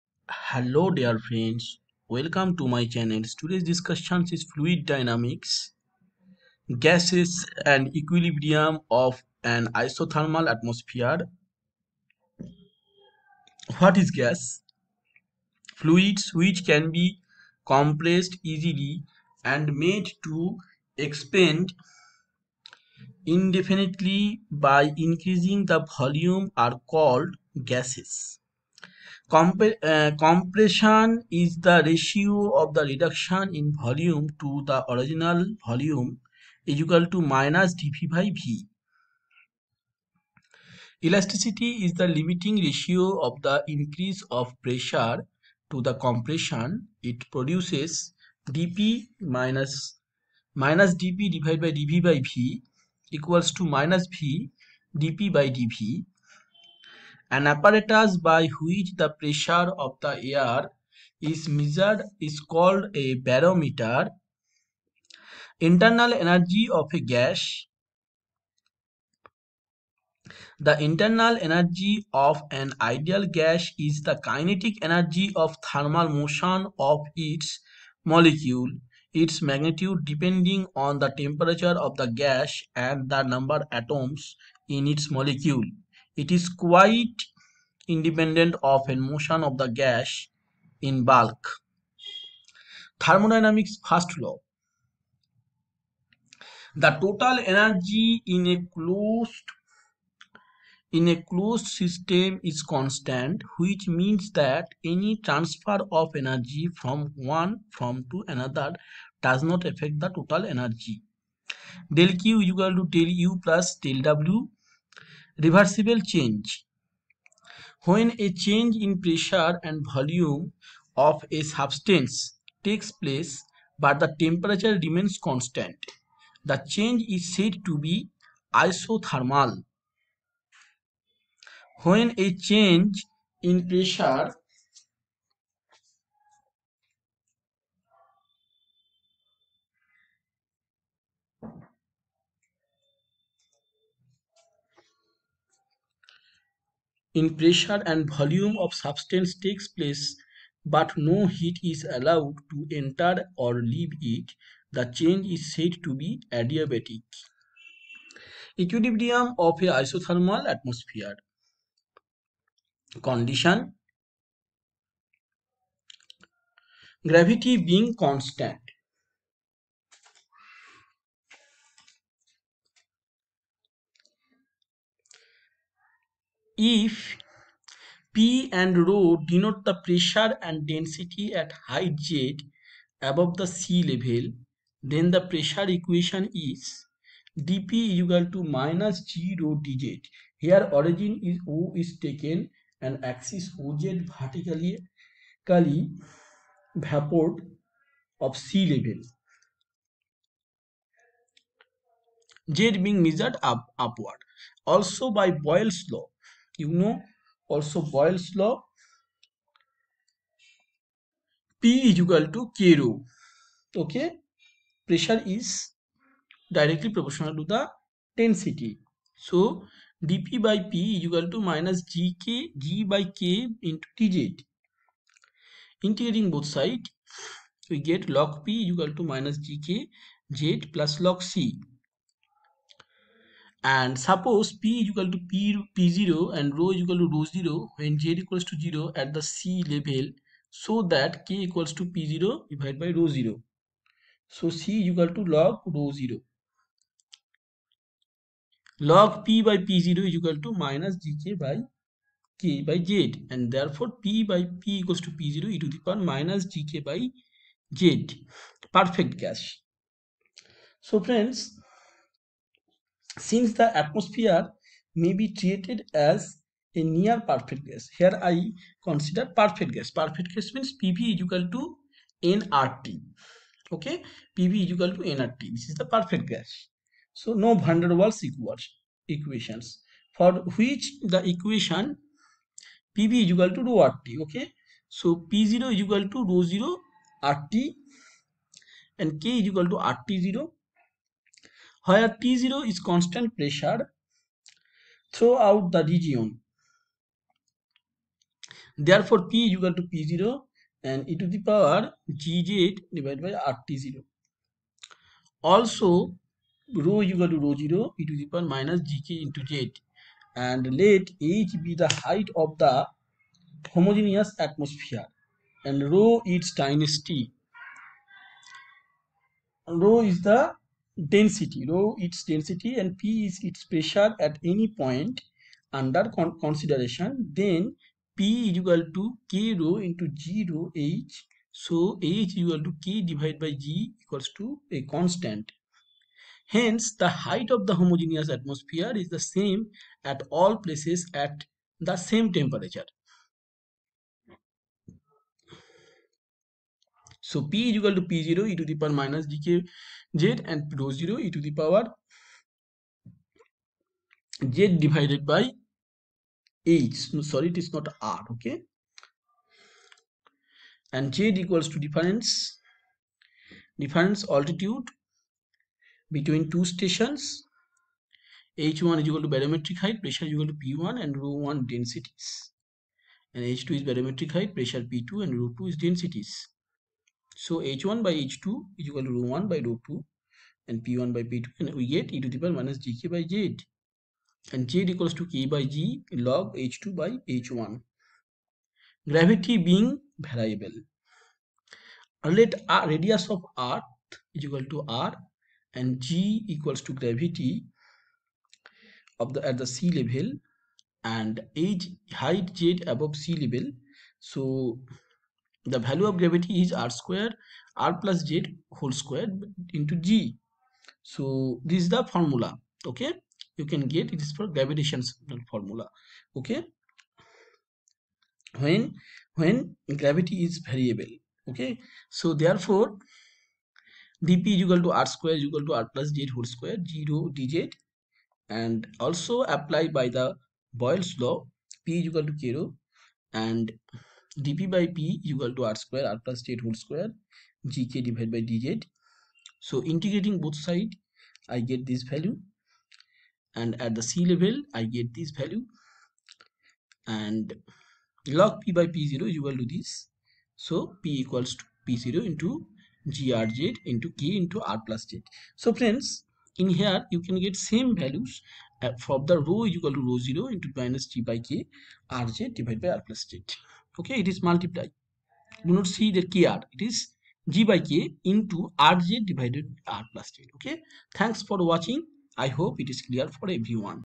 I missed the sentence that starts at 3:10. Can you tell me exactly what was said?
Here origin is O is taken and axis OZ vertically vapor of sea level.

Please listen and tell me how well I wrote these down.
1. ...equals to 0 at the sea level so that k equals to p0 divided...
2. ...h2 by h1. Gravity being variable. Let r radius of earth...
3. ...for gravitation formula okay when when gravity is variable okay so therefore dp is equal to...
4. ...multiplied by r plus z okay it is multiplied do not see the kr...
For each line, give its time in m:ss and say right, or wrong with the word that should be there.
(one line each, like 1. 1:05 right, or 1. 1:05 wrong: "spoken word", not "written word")
1. 3:58 right
2. 6:26 right
3. 6:54 right
4. 7:42 wrong: "divided", not "multiplied".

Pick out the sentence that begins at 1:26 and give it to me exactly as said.
It is quite independent of a motion of the gas in bulk.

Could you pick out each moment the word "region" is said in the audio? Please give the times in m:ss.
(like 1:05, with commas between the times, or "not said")
4:55.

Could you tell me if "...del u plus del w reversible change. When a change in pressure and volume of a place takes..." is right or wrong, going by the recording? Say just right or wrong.
wrong.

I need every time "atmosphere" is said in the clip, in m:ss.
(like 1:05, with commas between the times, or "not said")
0:10, 2:40, 4:23, 5:14, 5:38.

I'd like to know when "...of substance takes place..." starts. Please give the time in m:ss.
2:28.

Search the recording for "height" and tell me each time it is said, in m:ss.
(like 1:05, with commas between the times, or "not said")
3:01, 5:12, 5:37, 6:09, 6:14, 6:42.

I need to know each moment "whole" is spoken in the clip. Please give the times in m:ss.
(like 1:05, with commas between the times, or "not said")
6:48, 7:06, 7:16.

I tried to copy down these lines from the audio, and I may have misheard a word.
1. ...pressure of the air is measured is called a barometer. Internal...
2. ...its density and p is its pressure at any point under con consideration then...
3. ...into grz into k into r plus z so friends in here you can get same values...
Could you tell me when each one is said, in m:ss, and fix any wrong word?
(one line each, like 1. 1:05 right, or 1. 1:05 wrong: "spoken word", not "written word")
1. 0:59 right
2. 5:21 right
3. 7:32 right.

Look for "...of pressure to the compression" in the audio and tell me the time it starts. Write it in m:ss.
0:44.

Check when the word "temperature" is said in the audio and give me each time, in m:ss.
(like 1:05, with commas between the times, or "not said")
1:21, 2:04, 5:42.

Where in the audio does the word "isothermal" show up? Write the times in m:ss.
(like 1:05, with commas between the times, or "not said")
0:09, 2:08, 2:39.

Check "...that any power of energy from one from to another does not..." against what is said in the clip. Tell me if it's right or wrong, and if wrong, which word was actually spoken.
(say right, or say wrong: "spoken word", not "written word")
wrong: "transfer", not "power".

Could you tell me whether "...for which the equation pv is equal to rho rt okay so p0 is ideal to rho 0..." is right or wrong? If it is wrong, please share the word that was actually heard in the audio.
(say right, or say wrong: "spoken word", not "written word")
wrong: "equal", not "ideal".